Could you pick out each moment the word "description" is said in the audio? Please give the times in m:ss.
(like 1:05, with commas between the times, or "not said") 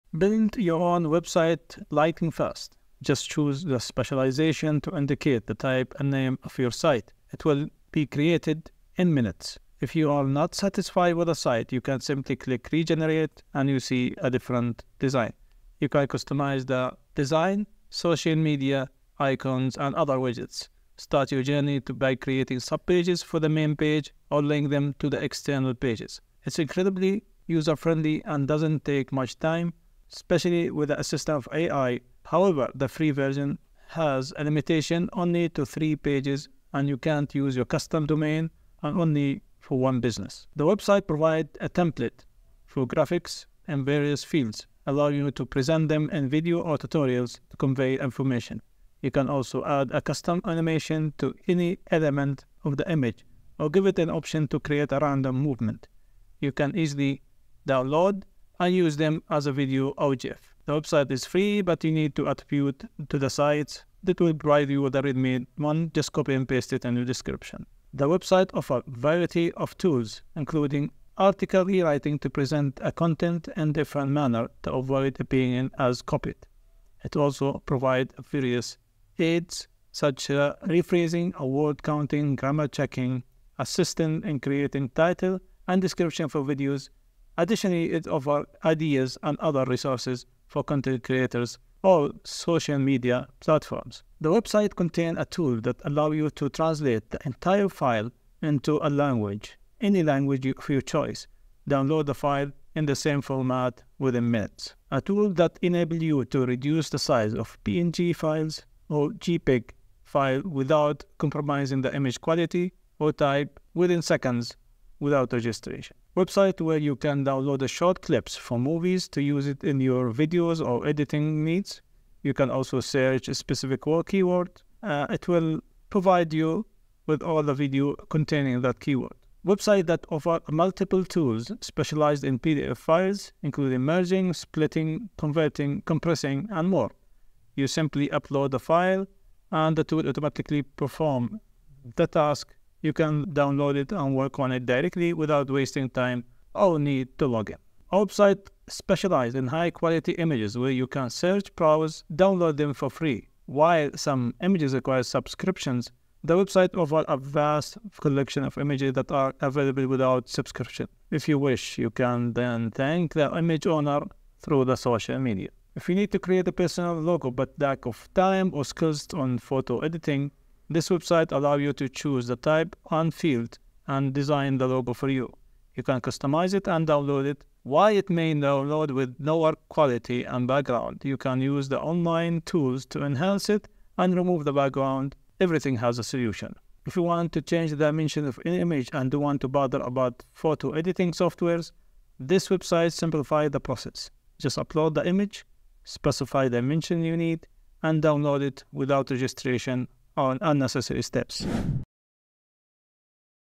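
1:07, 1:25.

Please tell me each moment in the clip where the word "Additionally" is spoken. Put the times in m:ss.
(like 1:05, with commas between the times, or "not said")
1:27.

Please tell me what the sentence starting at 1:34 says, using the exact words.
The website contains a tool that allows you to translate the entire file into a language, any language of your choice.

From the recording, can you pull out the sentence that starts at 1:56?
Website where you can download the short clips from movies to use it in your videos or editing needs.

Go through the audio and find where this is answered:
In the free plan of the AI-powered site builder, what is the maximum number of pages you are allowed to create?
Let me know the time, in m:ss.
0:35.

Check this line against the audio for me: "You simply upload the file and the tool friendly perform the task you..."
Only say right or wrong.
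wrong.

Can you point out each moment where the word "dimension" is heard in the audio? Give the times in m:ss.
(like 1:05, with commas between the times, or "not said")
3:07, 3:16.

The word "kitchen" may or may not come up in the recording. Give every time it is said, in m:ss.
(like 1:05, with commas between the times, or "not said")
not said.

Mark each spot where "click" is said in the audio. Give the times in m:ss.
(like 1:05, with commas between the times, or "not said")
0:12.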